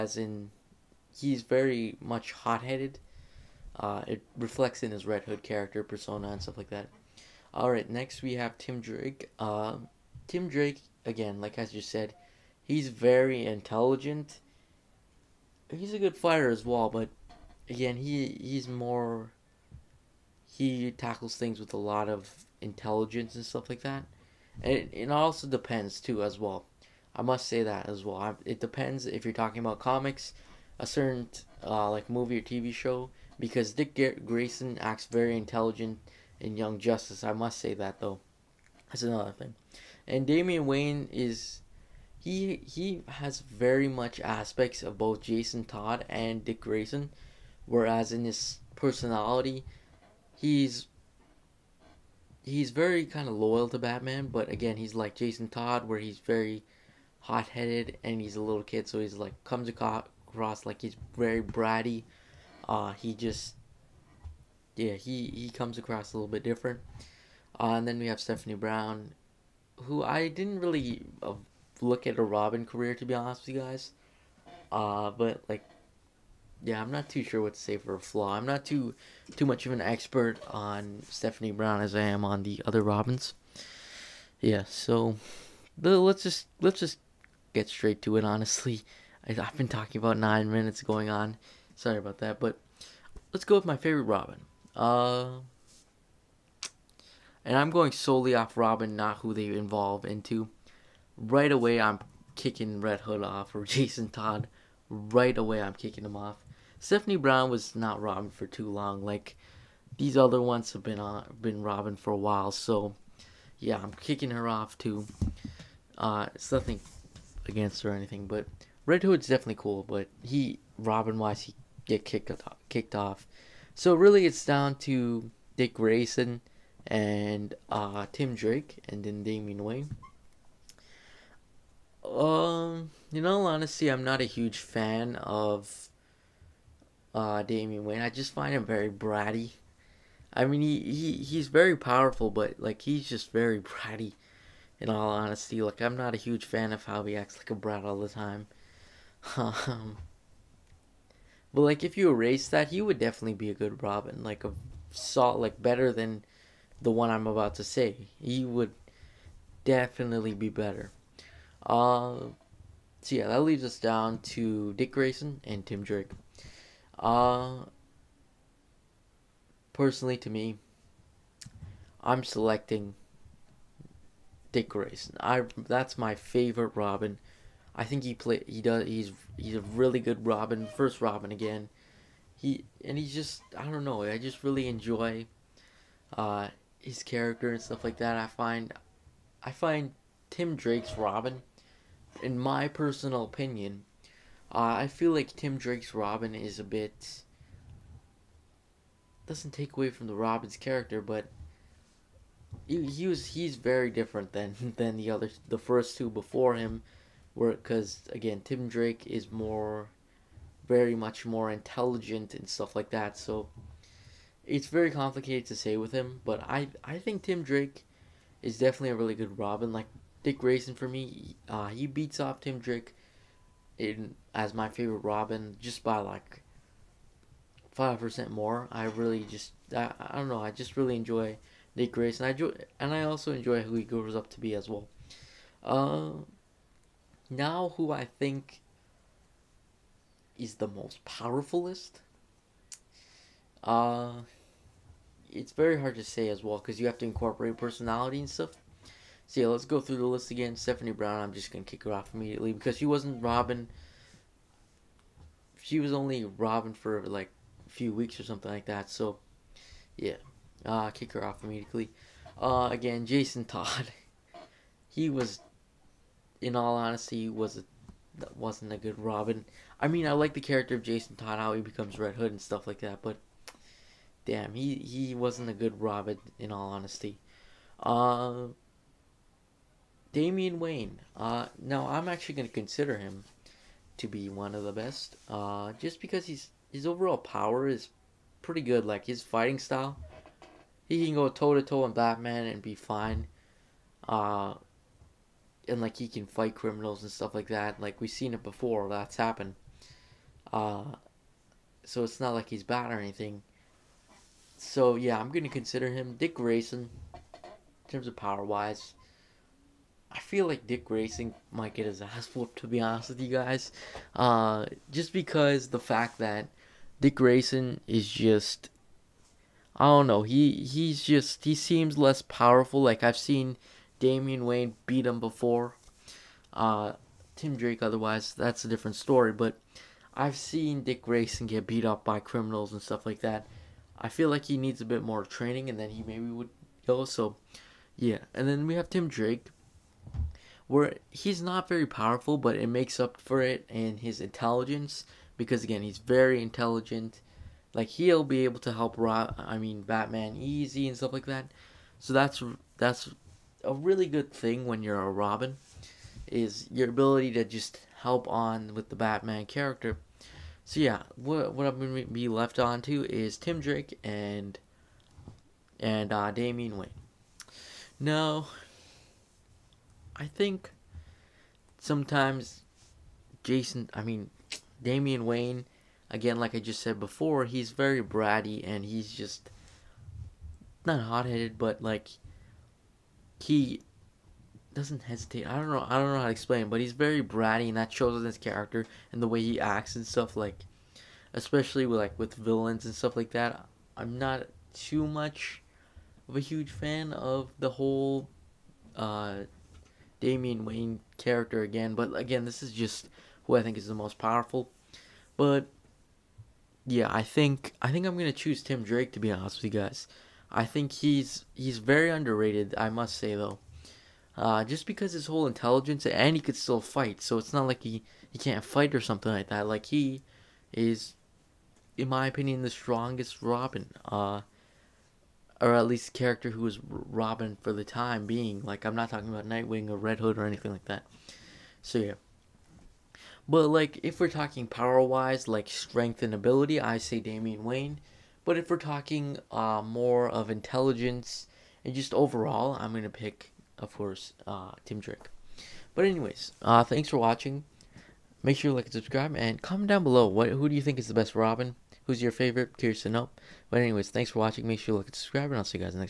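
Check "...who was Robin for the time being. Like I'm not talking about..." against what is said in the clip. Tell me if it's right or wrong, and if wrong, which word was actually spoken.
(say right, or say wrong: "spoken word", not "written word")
right.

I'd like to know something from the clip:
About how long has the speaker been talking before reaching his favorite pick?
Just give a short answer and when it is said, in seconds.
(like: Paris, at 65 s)
9 minutes, at 90 s.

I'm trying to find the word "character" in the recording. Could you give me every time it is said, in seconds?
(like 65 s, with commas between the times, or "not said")
5 s, 187 s, 200 s, 270 s, 359 s, 388 s, 401 s, 426 s.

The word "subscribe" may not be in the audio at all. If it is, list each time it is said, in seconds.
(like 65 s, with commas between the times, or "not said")
448 s, 455 s.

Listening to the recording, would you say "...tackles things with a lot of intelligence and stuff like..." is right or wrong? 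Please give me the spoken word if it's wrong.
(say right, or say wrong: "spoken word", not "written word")
right.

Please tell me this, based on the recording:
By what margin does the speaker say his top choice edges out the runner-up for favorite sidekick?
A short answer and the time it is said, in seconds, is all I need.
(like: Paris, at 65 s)
5 percent, at 227 s.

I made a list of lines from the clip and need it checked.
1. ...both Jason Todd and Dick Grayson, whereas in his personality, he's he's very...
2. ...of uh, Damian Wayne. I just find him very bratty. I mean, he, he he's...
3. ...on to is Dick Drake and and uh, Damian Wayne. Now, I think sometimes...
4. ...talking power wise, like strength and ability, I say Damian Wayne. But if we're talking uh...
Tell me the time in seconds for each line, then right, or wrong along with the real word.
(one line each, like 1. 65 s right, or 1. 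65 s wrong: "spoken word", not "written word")
1. 44 s right
2. 135 s right
3. 362 s wrong: "Tim", not "Dick"
4. 434 s right.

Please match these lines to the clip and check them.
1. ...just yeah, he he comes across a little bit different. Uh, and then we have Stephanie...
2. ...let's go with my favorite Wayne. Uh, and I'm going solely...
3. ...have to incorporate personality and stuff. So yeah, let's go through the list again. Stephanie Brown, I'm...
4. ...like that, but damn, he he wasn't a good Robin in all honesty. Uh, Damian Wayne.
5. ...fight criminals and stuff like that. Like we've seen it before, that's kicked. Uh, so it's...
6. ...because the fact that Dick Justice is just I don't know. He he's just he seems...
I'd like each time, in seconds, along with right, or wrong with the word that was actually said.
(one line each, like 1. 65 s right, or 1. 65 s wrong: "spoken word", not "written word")
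1. 63 s right
2. 93 s wrong: "Robin", not "Wayne"
3. 246 s right
4. 272 s right
5. 296 s wrong: "happened", not "kicked"
6. 315 s wrong: "Grayson", not "Justice".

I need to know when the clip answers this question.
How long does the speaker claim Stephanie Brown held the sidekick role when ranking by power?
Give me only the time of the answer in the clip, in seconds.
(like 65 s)
257 s.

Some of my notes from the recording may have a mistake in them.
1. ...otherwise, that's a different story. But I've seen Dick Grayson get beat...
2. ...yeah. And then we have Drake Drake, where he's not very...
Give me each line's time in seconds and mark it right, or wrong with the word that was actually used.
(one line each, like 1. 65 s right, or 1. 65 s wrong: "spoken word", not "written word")
1. 327 s right
2. 337 s wrong: "Tim", not "Drake".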